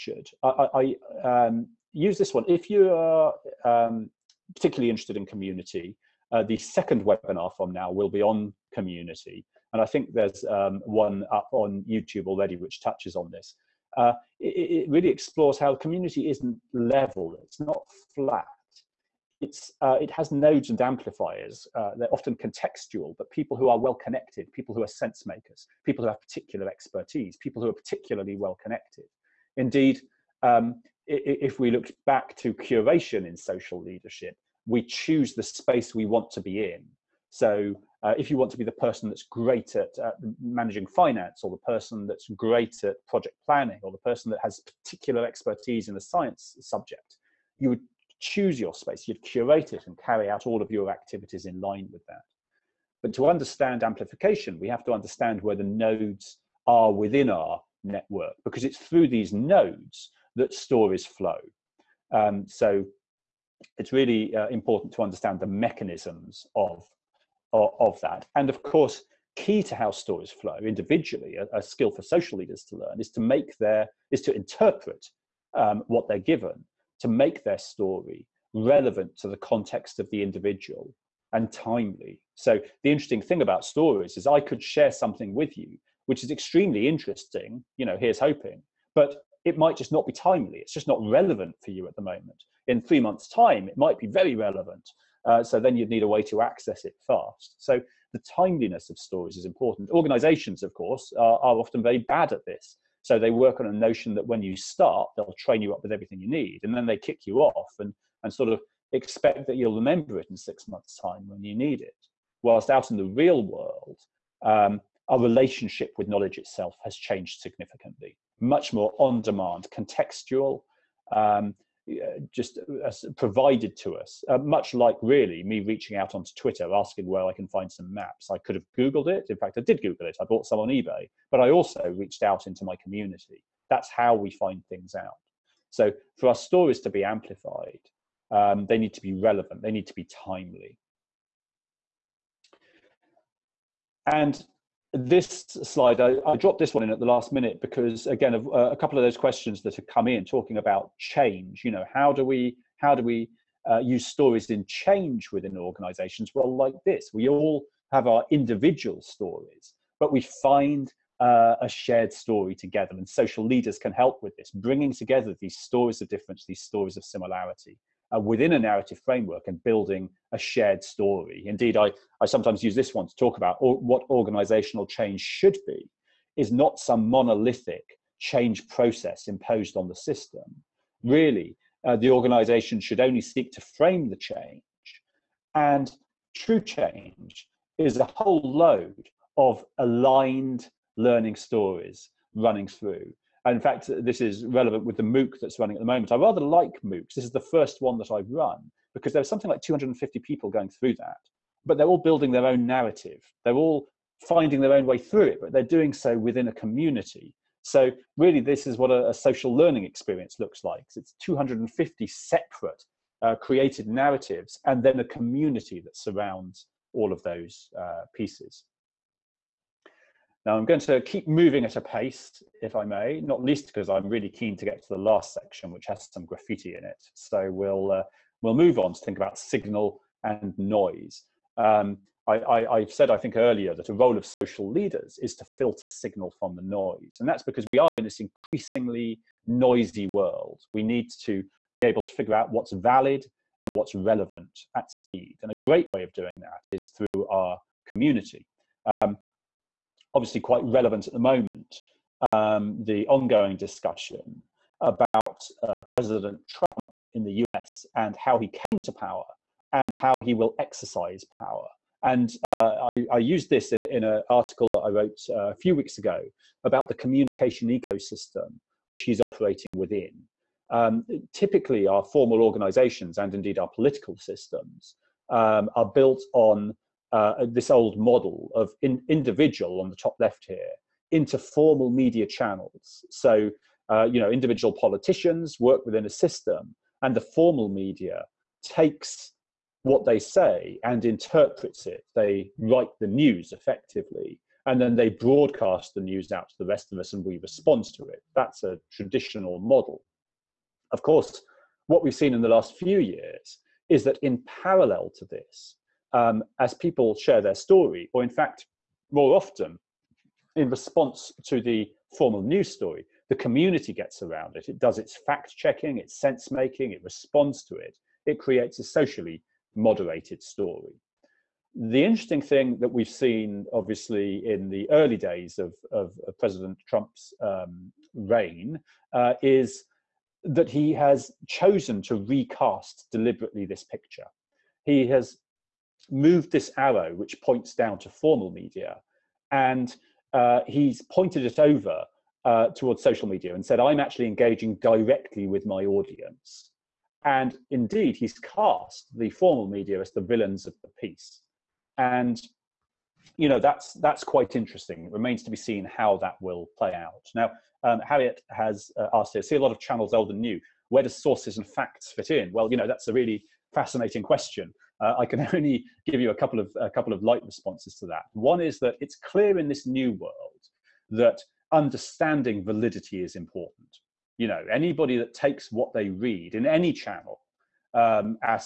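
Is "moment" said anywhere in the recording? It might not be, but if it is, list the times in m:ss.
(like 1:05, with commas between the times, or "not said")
1:32, 3:15, 4:11.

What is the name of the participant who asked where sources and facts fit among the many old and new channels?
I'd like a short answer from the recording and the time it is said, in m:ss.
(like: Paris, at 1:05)
Harriet, at 5:58.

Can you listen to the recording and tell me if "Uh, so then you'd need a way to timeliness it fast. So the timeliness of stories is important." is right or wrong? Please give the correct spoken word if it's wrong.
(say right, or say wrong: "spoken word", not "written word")
wrong: "access", not "timeliness".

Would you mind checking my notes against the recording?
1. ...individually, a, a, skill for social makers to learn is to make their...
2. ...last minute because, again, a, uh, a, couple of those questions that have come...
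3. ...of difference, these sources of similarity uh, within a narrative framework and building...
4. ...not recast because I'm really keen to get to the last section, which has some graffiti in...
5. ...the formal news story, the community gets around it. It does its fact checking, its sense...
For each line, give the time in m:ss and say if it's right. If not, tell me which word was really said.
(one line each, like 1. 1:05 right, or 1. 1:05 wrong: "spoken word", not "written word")
1. 1:10 wrong: "leaders", not "makers"
2. 2:27 right
3. 2:46 wrong: "stories", not "sources"
4. 3:43 wrong: "least", not "recast"
5. 5:11 right.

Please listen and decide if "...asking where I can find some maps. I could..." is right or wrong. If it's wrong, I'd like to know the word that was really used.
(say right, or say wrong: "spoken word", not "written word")
right.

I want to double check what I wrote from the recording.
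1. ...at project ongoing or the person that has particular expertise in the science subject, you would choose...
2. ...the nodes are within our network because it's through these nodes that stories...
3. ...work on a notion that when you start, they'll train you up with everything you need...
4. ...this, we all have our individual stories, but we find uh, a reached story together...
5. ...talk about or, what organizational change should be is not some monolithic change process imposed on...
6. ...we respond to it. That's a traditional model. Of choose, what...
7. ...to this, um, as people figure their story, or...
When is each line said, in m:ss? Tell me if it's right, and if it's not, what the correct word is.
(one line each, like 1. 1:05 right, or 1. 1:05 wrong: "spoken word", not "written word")
1. 0:42 wrong: "planning", not "ongoing"
2. 0:55 right
3. 1:43 right
4. 2:36 wrong: "shared", not "reached"
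5. 2:53 right
6. 4:57 wrong: "course", not "choose"
7. 5:05 wrong: "share", not "figure".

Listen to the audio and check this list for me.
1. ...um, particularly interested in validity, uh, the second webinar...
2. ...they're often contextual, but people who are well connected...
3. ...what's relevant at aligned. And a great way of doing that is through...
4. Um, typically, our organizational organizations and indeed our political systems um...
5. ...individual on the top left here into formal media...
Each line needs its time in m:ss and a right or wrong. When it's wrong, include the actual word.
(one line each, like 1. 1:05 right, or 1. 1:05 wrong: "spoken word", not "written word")
1. 0:03 wrong: "community", not "validity"
2. 0:21 right
3. 4:03 wrong: "speed", not "aligned"
4. 4:30 wrong: "formal", not "organizational"
5. 4:39 right.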